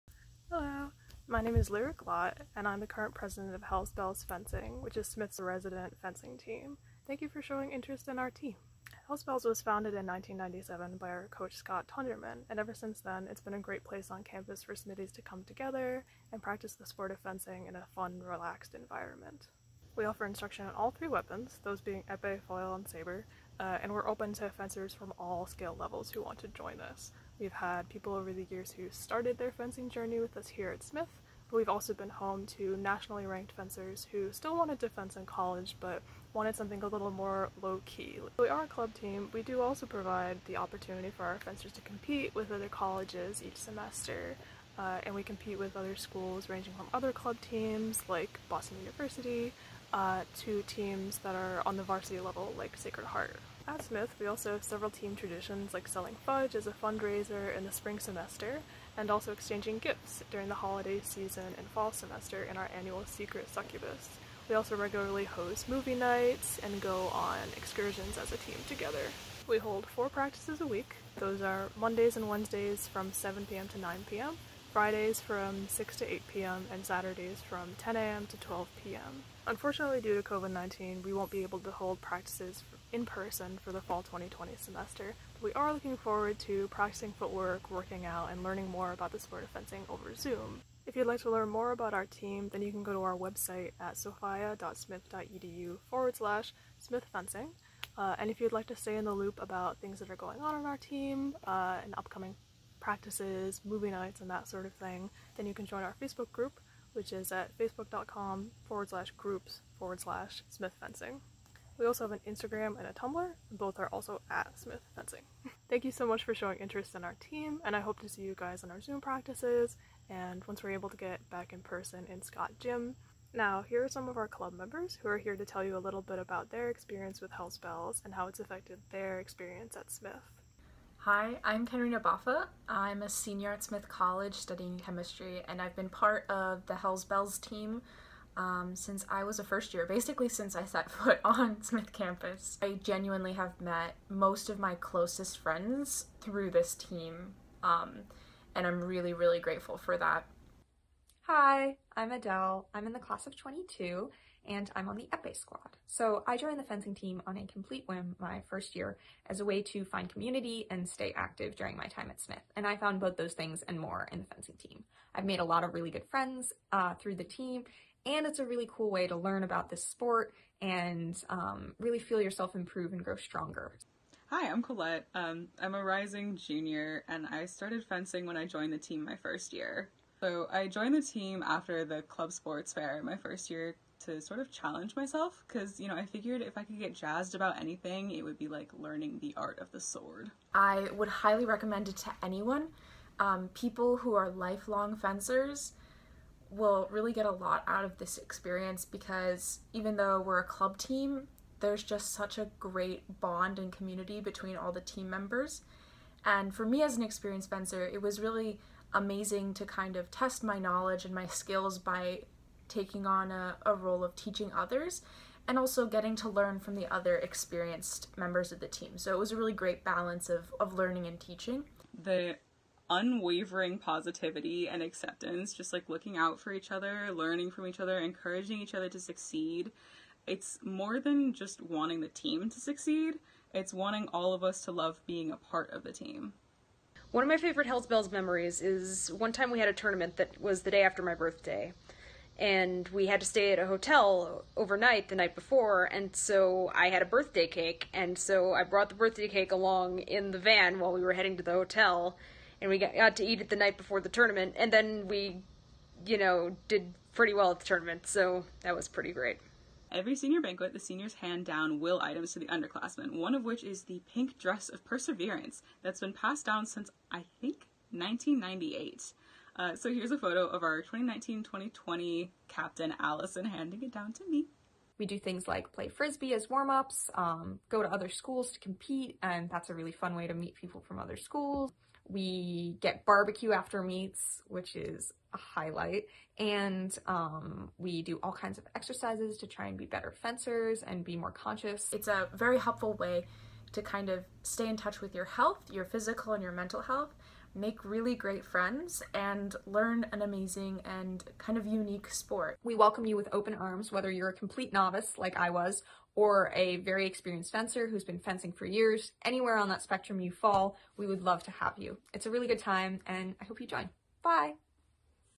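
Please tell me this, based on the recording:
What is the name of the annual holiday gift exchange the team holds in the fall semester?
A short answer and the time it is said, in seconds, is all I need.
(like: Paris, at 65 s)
Secret Succubus, at 63 s.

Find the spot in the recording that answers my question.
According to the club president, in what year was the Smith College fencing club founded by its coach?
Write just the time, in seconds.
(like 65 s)
10 s.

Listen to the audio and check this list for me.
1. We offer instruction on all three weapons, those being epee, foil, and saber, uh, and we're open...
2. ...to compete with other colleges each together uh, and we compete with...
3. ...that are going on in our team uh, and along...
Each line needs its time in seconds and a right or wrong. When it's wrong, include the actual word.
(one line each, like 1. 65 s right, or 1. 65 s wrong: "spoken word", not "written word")
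1. 19 s right
2. 41 s wrong: "semester", not "together"
3. 99 s wrong: "upcoming", not "along".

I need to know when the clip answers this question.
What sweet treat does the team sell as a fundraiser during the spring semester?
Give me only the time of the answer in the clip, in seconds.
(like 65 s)
56 s.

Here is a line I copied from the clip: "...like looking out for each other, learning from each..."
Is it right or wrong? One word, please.
right.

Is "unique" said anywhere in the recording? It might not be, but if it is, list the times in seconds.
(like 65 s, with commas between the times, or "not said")
301 s.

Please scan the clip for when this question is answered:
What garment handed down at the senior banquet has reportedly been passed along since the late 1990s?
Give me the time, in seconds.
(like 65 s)
264 s.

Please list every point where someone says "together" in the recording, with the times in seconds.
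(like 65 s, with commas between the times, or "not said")
15 s, 68 s.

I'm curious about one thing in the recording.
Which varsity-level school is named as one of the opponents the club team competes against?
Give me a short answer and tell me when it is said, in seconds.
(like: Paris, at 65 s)
Sacred Heart, at 52 s.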